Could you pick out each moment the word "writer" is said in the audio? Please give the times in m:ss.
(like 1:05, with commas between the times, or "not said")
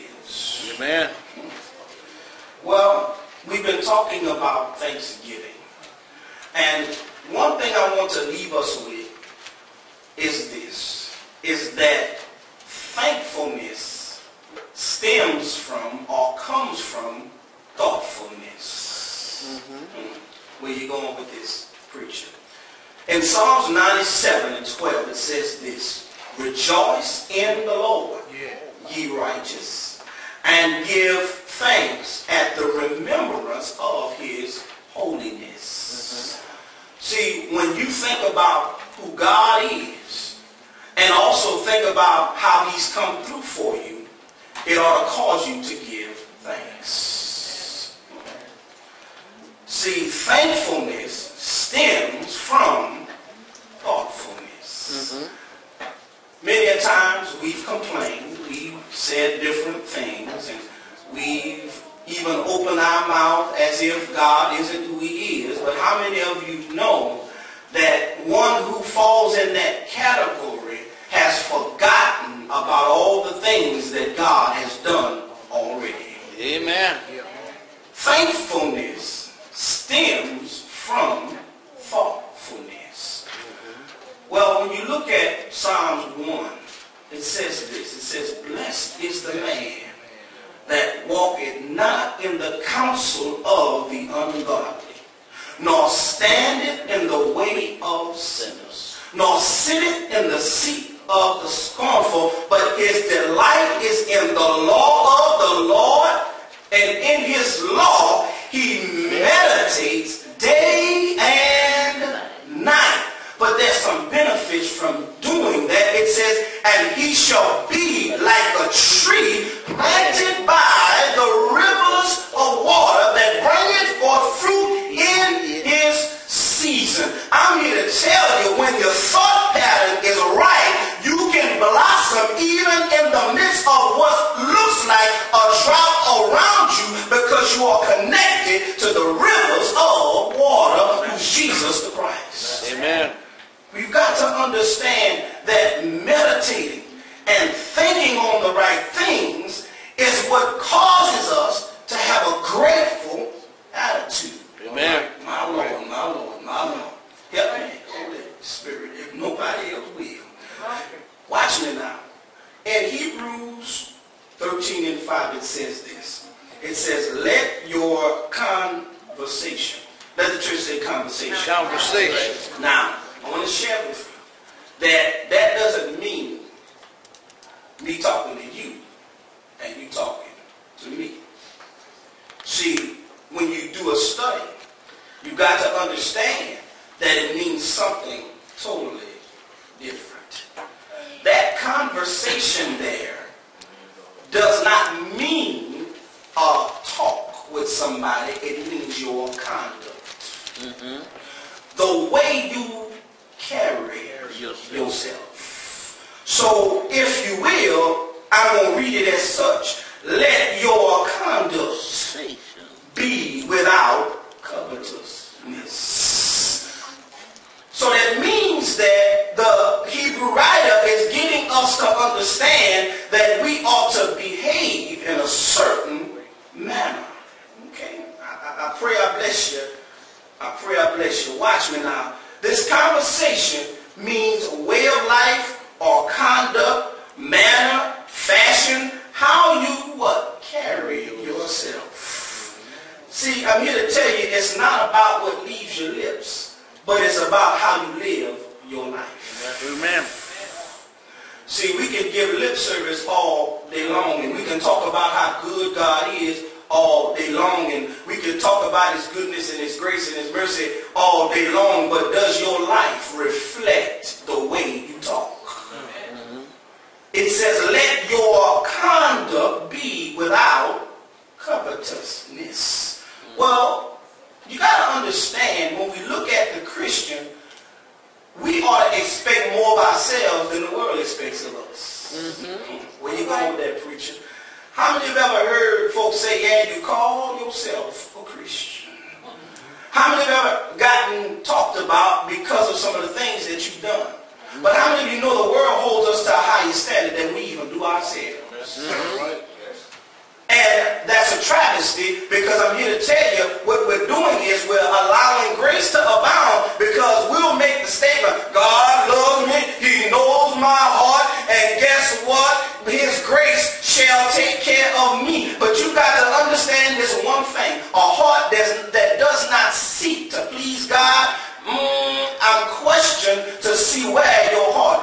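3:40.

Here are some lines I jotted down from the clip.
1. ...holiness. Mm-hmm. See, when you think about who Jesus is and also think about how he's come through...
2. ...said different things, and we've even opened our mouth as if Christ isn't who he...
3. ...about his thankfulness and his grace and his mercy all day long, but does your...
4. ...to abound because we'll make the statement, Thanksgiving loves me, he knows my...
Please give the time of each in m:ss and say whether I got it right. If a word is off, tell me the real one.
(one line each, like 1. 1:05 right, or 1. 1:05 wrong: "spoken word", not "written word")
1. 0:34 wrong: "God", not "Jesus"
2. 0:58 wrong: "God", not "Christ"
3. 4:18 wrong: "goodness", not "thankfulness"
4. 5:05 wrong: "God", not "Thanksgiving".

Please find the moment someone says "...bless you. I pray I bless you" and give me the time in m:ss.
3:49.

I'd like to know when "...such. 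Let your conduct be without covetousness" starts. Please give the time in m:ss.
3:29.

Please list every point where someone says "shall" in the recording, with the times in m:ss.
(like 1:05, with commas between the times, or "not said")
1:57, 5:13.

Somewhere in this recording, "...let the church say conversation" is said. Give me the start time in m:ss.
2:50.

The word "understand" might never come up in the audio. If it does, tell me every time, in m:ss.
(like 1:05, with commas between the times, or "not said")
2:24, 3:05, 3:41, 4:35, 5:16.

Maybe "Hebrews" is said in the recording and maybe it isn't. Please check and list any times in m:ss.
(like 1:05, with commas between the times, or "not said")
2:42, 3:39.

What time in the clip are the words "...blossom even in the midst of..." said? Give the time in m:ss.
2:11.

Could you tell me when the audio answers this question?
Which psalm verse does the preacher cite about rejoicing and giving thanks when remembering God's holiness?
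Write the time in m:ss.
0:23.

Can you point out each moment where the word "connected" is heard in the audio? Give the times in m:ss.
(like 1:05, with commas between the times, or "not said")
2:17.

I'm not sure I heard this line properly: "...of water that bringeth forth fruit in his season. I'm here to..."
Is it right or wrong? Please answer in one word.
right.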